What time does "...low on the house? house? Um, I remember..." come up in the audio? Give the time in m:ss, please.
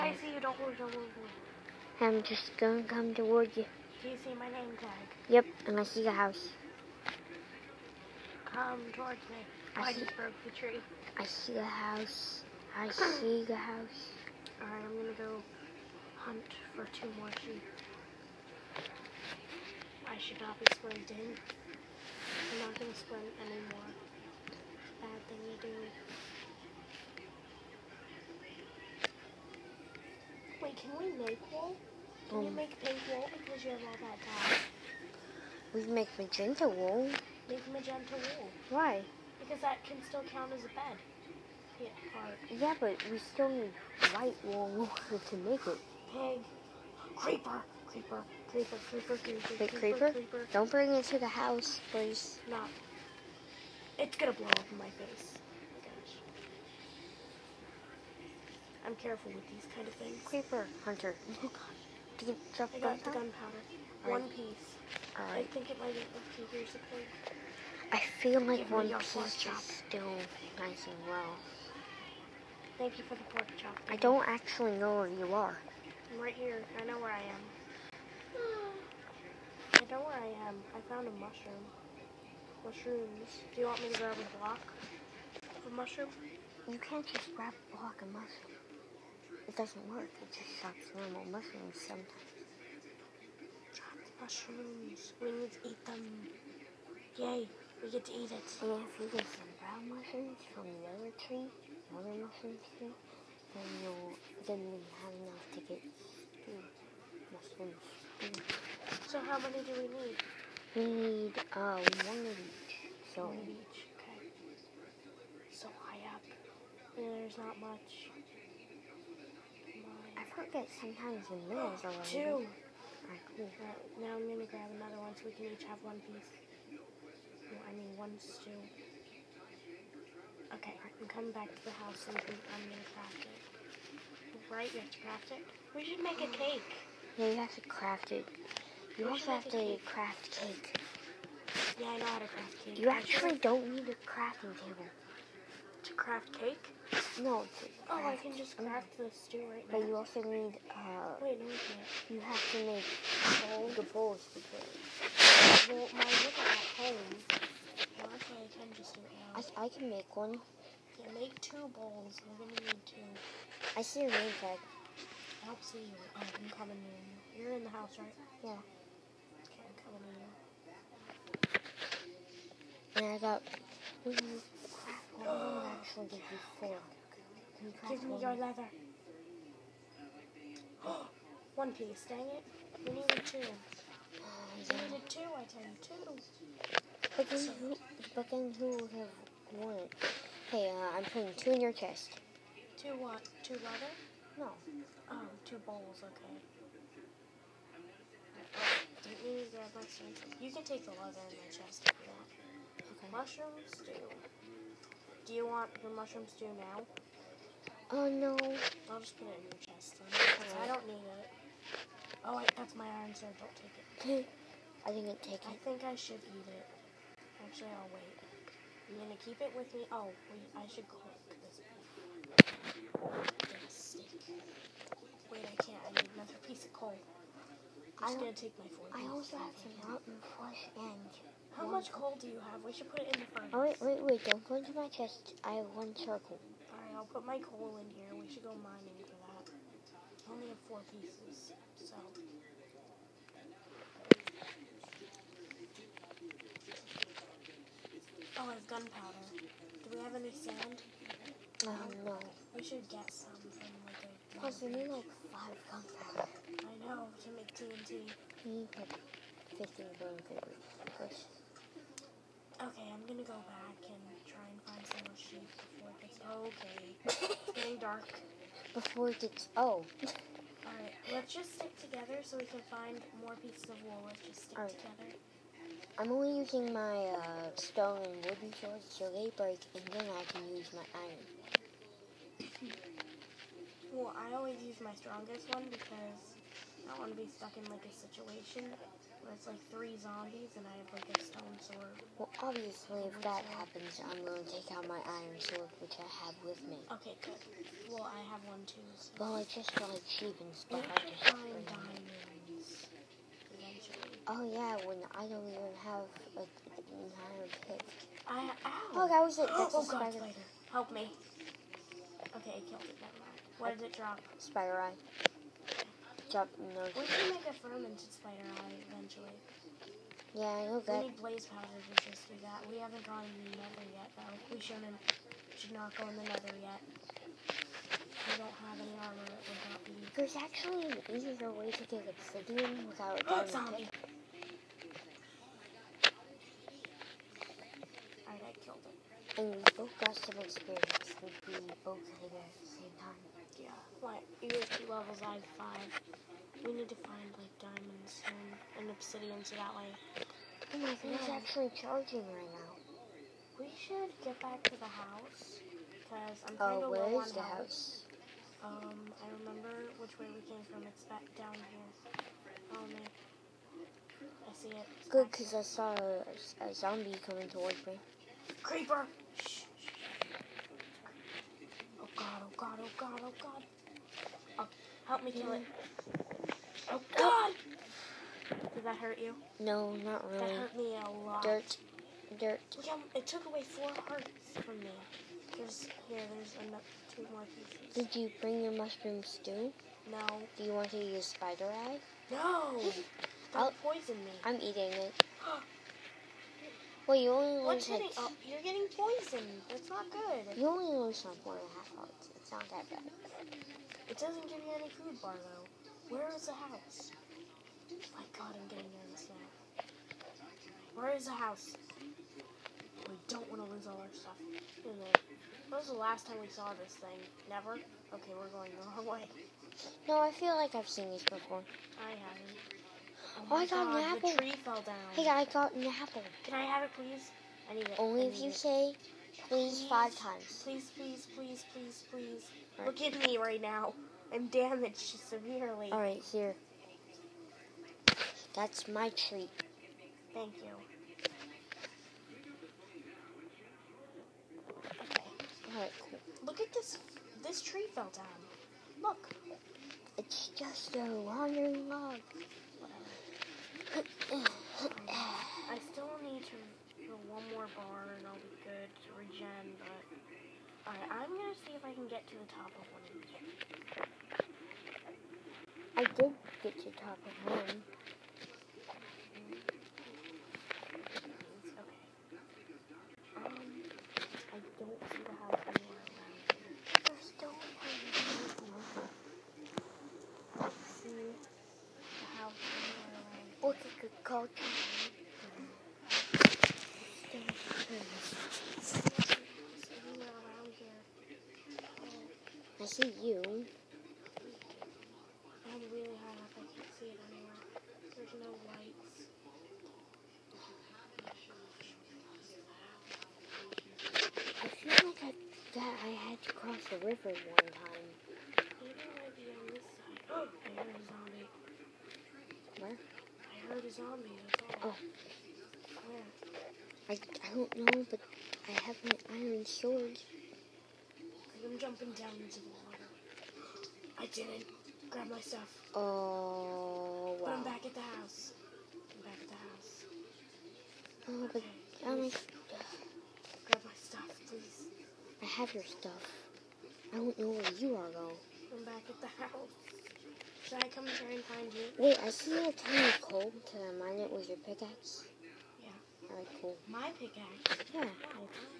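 5:56.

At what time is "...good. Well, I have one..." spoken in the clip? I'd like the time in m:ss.
4:57.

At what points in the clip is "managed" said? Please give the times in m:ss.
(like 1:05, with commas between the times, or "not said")
not said.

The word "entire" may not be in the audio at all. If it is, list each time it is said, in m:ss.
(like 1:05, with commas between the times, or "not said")
5:07.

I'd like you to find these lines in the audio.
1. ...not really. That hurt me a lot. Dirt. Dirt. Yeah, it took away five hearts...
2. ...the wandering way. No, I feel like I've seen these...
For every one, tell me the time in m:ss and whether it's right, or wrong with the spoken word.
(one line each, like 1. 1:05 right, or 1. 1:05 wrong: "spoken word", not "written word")
1. 6:20 wrong: "four", not "five"
2. 6:58 wrong: "wrong", not "wandering".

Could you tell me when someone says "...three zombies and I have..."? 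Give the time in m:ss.
4:49.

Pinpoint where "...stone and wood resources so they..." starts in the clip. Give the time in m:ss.
4:37.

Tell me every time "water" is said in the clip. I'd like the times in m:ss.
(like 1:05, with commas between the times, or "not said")
8:42.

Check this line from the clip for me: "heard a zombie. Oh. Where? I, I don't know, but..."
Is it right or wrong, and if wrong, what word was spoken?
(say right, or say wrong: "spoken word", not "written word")
right.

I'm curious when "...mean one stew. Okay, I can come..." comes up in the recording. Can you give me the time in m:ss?
2:07.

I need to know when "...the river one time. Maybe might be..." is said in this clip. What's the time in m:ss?
8:26.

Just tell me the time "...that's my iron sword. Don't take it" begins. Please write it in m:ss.
3:32.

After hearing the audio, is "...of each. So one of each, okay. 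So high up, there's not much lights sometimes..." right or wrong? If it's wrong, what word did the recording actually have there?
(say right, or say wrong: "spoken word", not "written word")
wrong: "crickets", not "lights".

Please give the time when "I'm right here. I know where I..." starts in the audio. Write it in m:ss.
1:16.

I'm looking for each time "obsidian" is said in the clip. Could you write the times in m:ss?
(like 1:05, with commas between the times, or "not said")
5:32, 5:48.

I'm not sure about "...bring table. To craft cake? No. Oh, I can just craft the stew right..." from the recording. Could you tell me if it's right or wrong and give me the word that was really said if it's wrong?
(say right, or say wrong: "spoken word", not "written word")
wrong: "crafting", not "bring".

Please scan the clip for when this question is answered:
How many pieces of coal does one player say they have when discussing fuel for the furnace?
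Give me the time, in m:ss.
3:59.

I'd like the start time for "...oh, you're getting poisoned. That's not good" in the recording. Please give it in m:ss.
6:38.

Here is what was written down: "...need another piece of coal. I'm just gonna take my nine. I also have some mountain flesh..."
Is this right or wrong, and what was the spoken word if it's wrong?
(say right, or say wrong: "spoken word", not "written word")
wrong: "four", not "nine".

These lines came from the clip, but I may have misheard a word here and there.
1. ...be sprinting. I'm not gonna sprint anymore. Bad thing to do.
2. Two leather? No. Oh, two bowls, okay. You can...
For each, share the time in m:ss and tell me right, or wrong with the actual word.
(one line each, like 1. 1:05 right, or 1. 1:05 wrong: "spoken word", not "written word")
1. 0:20 right
2. 3:13 right.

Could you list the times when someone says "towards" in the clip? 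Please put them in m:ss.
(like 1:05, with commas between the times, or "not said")
0:03, 0:08, 6:07.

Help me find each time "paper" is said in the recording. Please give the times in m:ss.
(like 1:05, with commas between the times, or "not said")
4:20.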